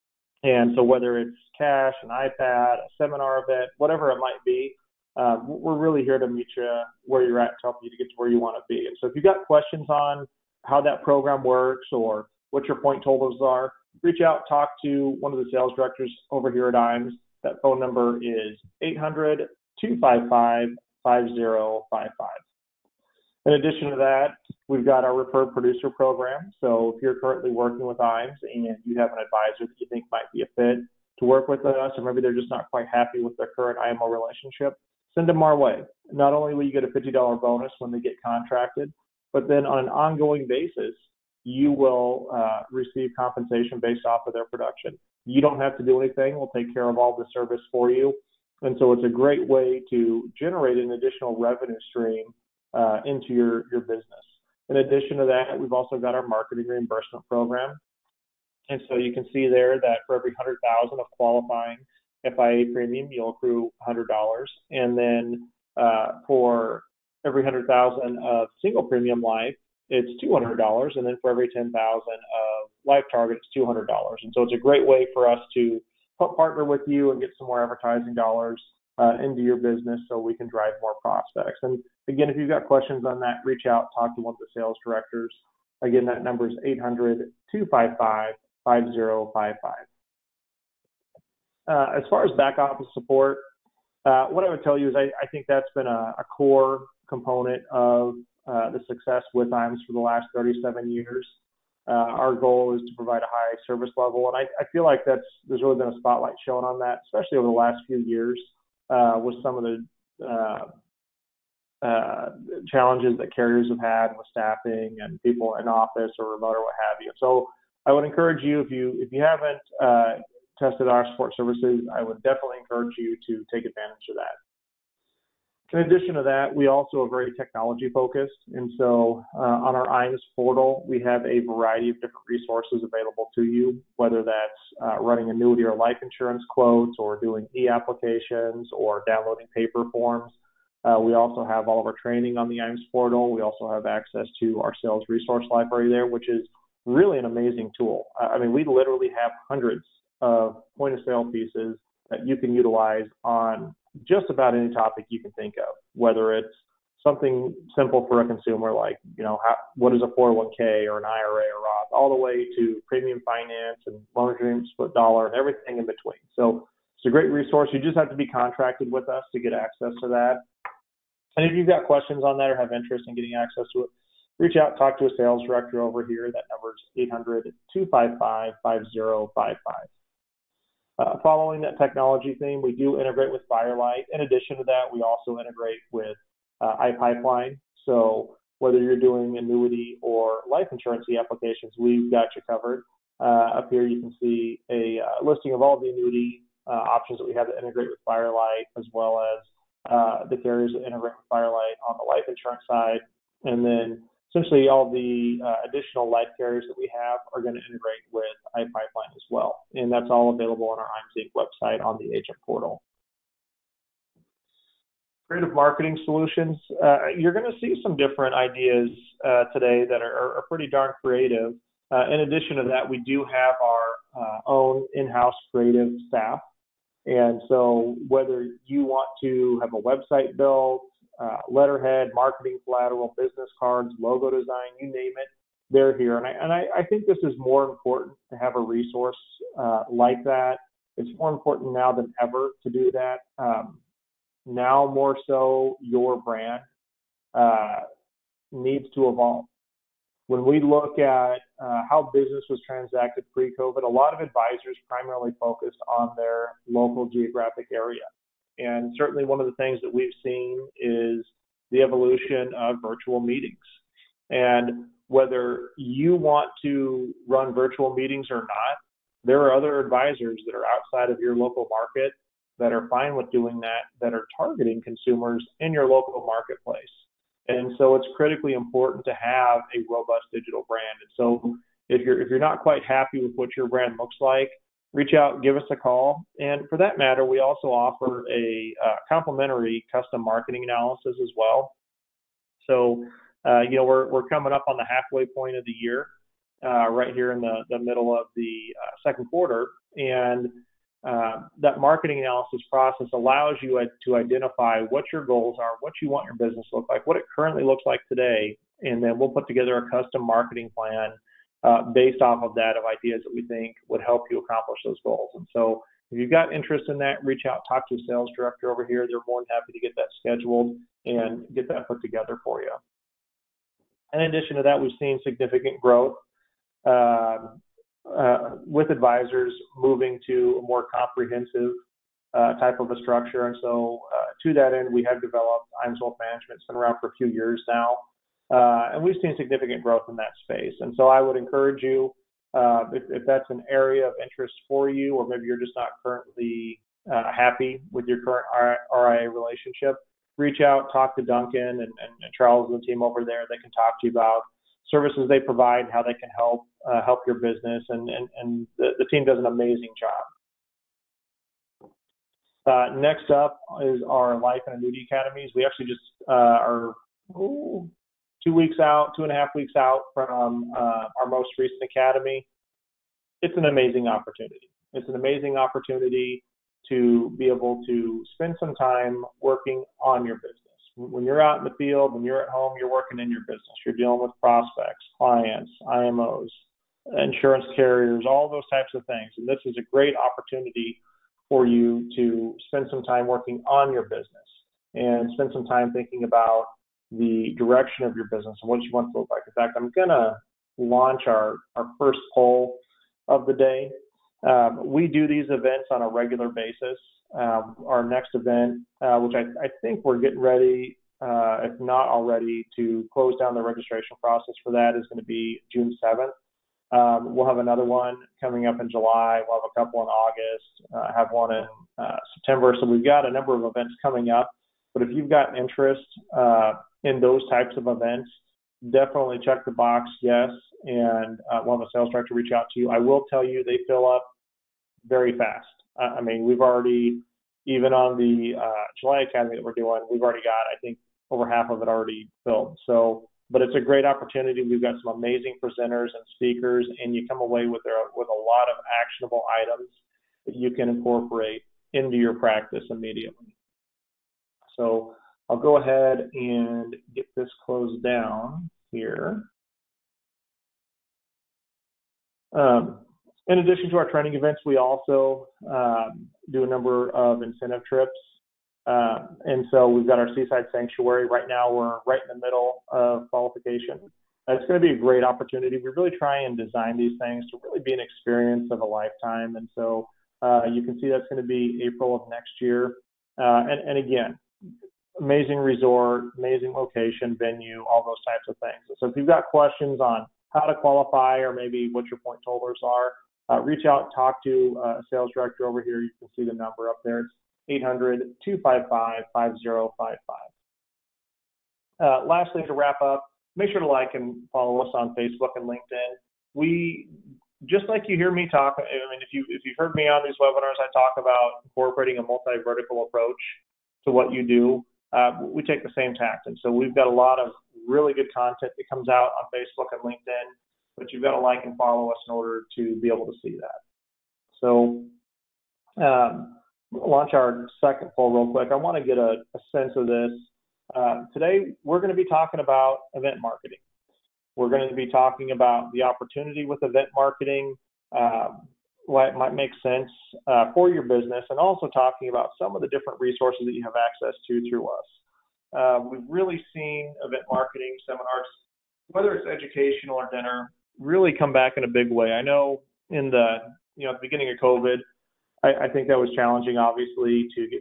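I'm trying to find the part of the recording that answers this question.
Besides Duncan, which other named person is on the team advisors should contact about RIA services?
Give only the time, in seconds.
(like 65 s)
352 s.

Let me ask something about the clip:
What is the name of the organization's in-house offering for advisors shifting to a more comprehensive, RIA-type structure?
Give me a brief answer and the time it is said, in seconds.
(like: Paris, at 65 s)
IAMS Wealth Management, at 335 s.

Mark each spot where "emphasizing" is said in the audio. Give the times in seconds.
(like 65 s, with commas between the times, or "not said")
not said.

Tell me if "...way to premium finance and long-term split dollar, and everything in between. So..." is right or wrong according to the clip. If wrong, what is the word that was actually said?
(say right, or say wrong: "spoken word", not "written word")
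right.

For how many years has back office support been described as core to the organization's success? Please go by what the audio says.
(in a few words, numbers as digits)
37.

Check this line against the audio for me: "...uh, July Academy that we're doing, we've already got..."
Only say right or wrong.
right.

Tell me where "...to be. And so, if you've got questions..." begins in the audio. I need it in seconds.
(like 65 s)
8 s.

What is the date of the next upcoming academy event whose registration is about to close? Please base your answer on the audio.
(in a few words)
June 7th.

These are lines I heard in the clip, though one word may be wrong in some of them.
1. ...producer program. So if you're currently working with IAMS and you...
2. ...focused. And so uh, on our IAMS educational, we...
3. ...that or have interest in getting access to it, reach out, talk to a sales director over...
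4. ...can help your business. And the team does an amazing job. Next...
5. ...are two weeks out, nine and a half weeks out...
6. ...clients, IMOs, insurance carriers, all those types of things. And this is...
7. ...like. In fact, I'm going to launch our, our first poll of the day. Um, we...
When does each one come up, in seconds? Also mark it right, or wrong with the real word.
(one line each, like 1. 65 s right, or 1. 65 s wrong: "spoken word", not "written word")
1. 25 s right
2. 127 s wrong: "portal", not "educational"
3. 172 s right
4. 356 s right
5. 366 s wrong: "two", not "nine"
6. 385 s right
7. 399 s right.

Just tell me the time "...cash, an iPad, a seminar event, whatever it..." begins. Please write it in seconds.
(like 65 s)
1 s.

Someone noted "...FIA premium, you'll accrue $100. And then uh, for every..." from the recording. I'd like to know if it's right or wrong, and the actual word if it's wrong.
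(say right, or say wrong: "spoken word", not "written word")
right.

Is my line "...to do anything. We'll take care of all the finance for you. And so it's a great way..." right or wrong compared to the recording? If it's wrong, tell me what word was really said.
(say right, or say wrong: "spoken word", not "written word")
wrong: "service", not "finance".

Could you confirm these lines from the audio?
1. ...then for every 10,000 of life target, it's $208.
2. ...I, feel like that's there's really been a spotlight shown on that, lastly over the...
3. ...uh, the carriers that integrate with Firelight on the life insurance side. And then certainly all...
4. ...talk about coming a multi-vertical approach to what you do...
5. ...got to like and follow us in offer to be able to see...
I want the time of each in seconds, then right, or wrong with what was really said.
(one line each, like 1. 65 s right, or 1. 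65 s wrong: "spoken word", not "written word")
1. 71 s wrong: "200", not "208"
2. 104 s wrong: "especially", not "lastly"
3. 199 s wrong: "essentially", not "certainly"
4. 510 s wrong: "incorporating", not "coming"
5. 521 s wrong: "order", not "offer".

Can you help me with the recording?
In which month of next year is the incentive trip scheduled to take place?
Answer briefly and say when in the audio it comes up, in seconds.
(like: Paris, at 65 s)
April, at 481 s.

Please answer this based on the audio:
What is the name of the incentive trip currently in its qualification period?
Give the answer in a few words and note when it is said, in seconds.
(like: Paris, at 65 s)
Seaside Sanctuary, at 470 s.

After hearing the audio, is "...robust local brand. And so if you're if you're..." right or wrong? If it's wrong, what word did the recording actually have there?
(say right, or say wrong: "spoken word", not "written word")
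wrong: "digital", not "local".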